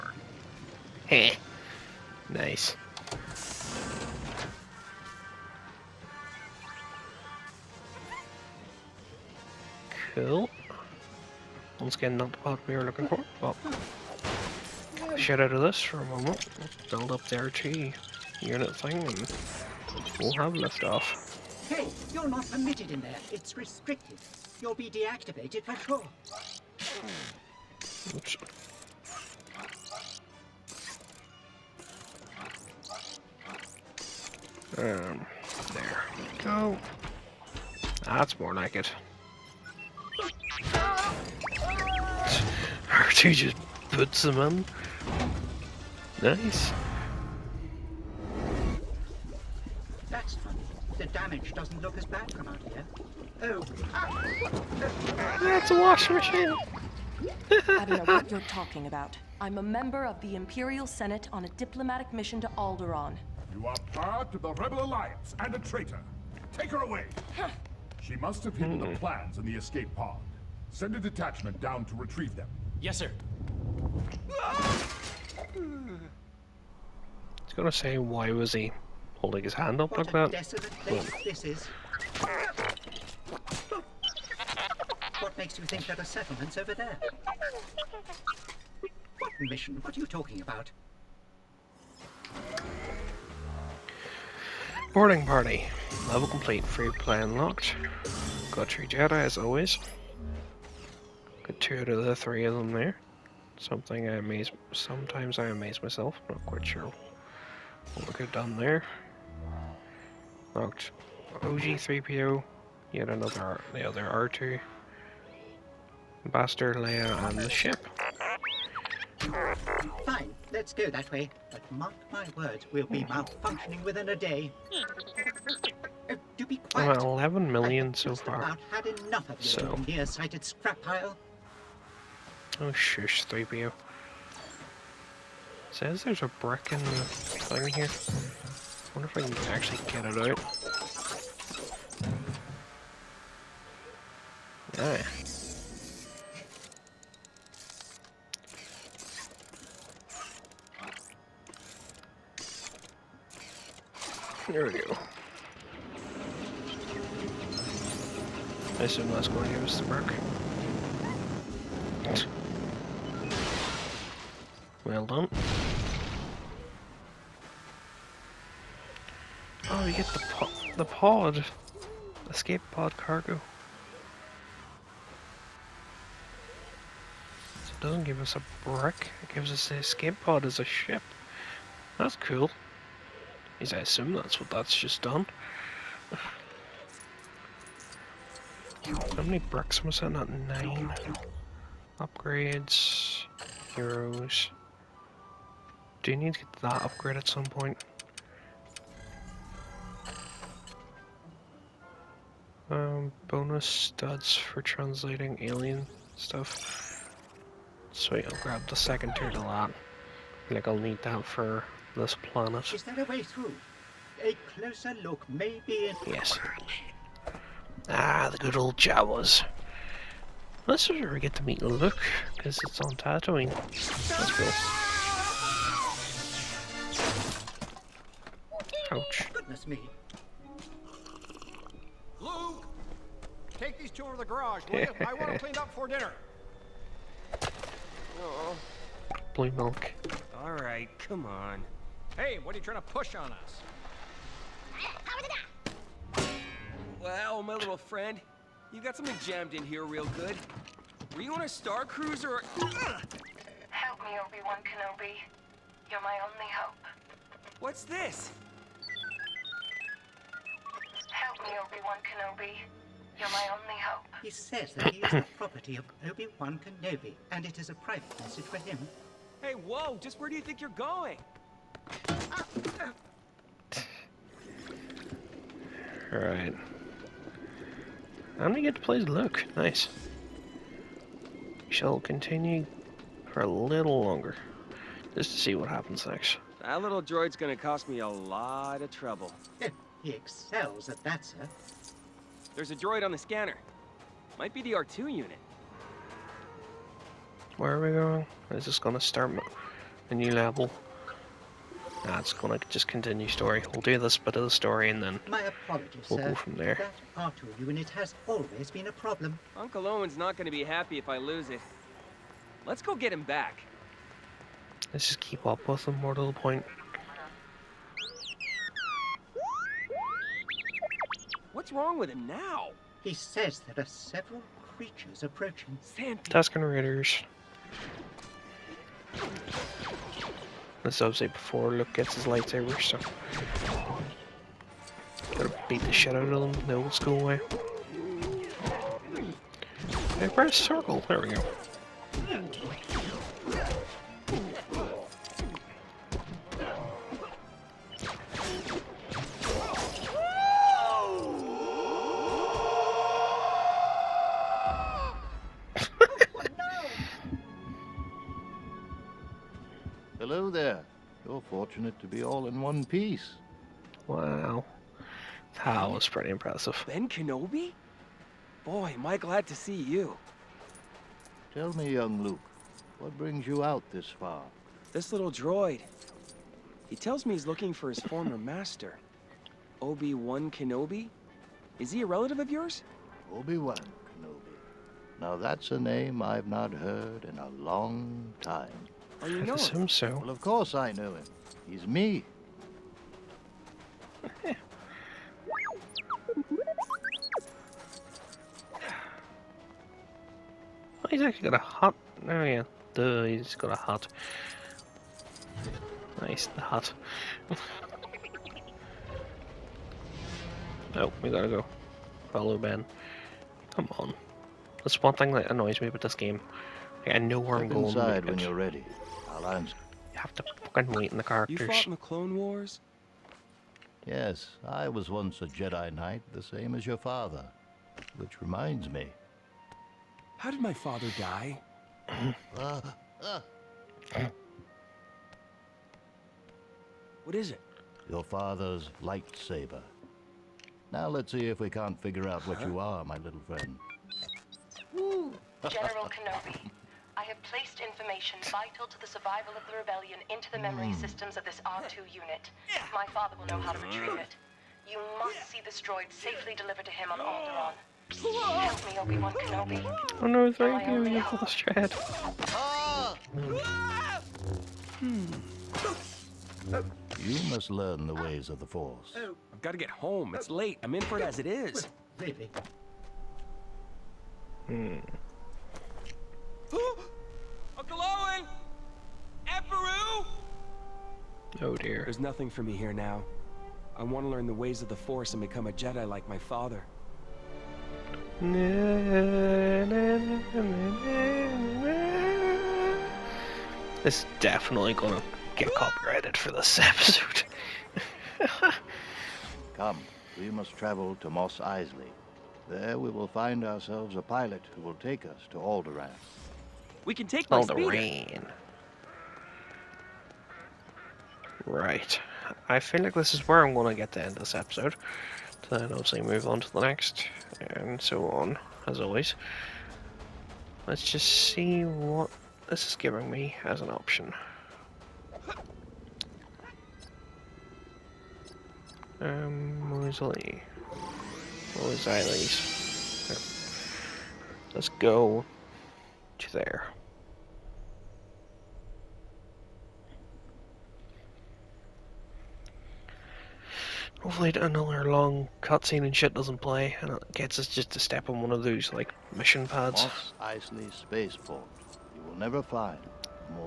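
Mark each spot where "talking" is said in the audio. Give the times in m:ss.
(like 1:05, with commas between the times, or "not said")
0:58, 1:30.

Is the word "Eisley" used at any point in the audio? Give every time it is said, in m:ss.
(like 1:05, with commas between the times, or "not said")
8:21, 9:10.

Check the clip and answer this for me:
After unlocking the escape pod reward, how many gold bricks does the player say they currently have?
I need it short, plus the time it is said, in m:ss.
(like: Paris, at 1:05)
9, at 3:10.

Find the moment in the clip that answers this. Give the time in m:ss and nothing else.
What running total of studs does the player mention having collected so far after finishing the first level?
2:07.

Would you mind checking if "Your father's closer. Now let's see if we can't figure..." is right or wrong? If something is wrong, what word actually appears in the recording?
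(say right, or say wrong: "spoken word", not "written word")
wrong: "lightsaber", not "closer".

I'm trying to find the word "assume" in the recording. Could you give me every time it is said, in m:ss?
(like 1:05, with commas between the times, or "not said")
2:38, 3:03, 6:29.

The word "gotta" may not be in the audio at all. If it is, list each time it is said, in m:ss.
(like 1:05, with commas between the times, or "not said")
5:35, 6:51.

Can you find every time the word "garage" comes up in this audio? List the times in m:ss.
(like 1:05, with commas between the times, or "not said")
3:54.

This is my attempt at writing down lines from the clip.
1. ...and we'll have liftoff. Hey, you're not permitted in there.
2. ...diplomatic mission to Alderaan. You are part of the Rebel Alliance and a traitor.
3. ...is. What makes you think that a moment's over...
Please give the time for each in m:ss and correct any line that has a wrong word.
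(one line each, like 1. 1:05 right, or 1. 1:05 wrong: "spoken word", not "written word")
1. 0:18 right
2. 1:01 right
3. 1:21 wrong: "settlement", not "moment".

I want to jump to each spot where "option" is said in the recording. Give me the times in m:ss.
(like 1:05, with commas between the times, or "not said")
8:43.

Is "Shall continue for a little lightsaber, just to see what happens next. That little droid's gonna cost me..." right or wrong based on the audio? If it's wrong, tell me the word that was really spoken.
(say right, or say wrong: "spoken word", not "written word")
wrong: "longer", not "lightsaber".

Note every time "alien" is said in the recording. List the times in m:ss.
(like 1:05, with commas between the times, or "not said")
3:25.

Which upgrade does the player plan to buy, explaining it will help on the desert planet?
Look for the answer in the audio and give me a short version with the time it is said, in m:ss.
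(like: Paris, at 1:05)
Bonus studs for translating, at 3:23.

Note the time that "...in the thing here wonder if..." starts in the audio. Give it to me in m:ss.
2:16.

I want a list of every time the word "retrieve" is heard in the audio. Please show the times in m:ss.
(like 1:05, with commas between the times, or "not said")
1:11, 7:33.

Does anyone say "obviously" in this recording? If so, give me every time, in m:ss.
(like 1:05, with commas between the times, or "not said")
8:35.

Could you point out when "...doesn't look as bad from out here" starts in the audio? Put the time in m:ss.
0:51.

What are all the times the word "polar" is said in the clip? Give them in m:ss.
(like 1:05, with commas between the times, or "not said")
not said.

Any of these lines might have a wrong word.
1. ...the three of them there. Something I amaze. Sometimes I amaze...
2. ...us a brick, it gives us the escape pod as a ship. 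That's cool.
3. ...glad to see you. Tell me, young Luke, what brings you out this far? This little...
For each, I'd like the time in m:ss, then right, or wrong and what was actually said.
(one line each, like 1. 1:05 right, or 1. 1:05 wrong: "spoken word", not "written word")
1. 1:42 right
2. 2:58 right
3. 6:09 right.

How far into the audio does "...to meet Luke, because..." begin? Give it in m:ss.
3:41.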